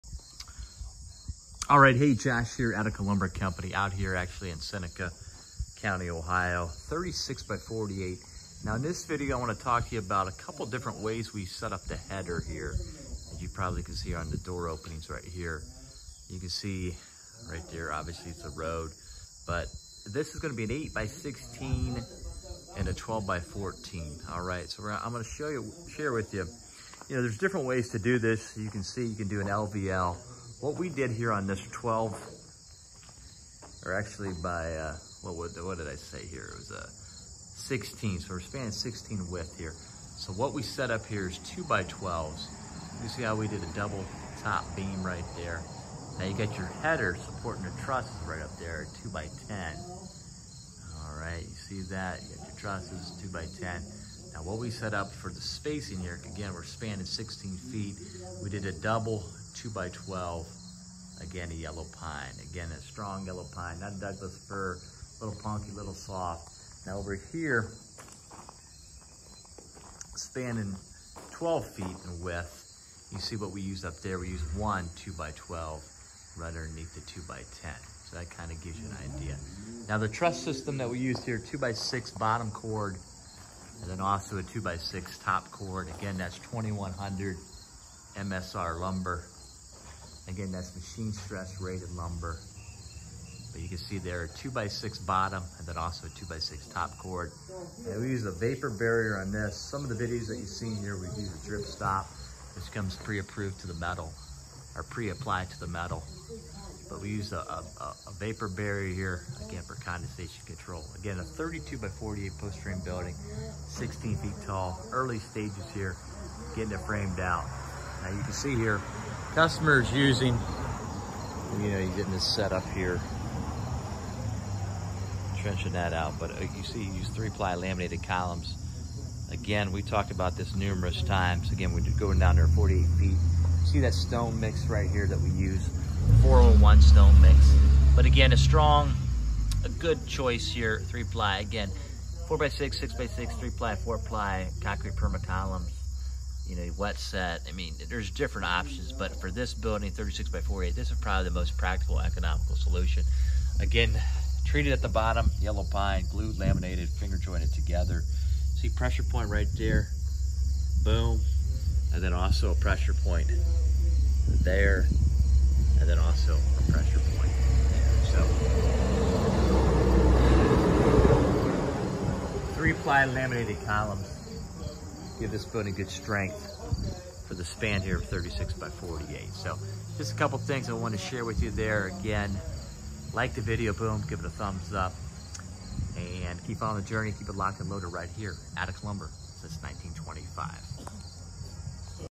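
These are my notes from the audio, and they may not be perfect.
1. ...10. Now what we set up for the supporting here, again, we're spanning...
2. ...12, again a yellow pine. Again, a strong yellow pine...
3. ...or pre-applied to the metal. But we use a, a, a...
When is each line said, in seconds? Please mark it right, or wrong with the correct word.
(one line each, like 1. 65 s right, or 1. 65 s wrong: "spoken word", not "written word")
1. 53 s wrong: "spacing", not "supporting"
2. 59 s right
3. 104 s right.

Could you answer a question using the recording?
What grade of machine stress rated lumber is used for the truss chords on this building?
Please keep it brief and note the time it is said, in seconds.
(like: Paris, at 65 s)
2100 MSR, at 86 s.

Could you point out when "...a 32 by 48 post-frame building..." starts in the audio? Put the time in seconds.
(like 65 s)
111 s.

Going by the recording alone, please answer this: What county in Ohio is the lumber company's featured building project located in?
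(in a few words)
Seneca County.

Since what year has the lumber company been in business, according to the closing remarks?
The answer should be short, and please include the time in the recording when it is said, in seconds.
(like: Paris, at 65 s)
1925, at 189 s.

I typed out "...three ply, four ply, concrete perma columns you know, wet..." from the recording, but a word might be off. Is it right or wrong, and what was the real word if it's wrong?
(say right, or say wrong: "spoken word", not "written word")
right.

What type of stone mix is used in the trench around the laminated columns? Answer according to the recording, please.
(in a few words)
401 stone mix.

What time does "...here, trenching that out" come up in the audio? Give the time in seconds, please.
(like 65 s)
122 s.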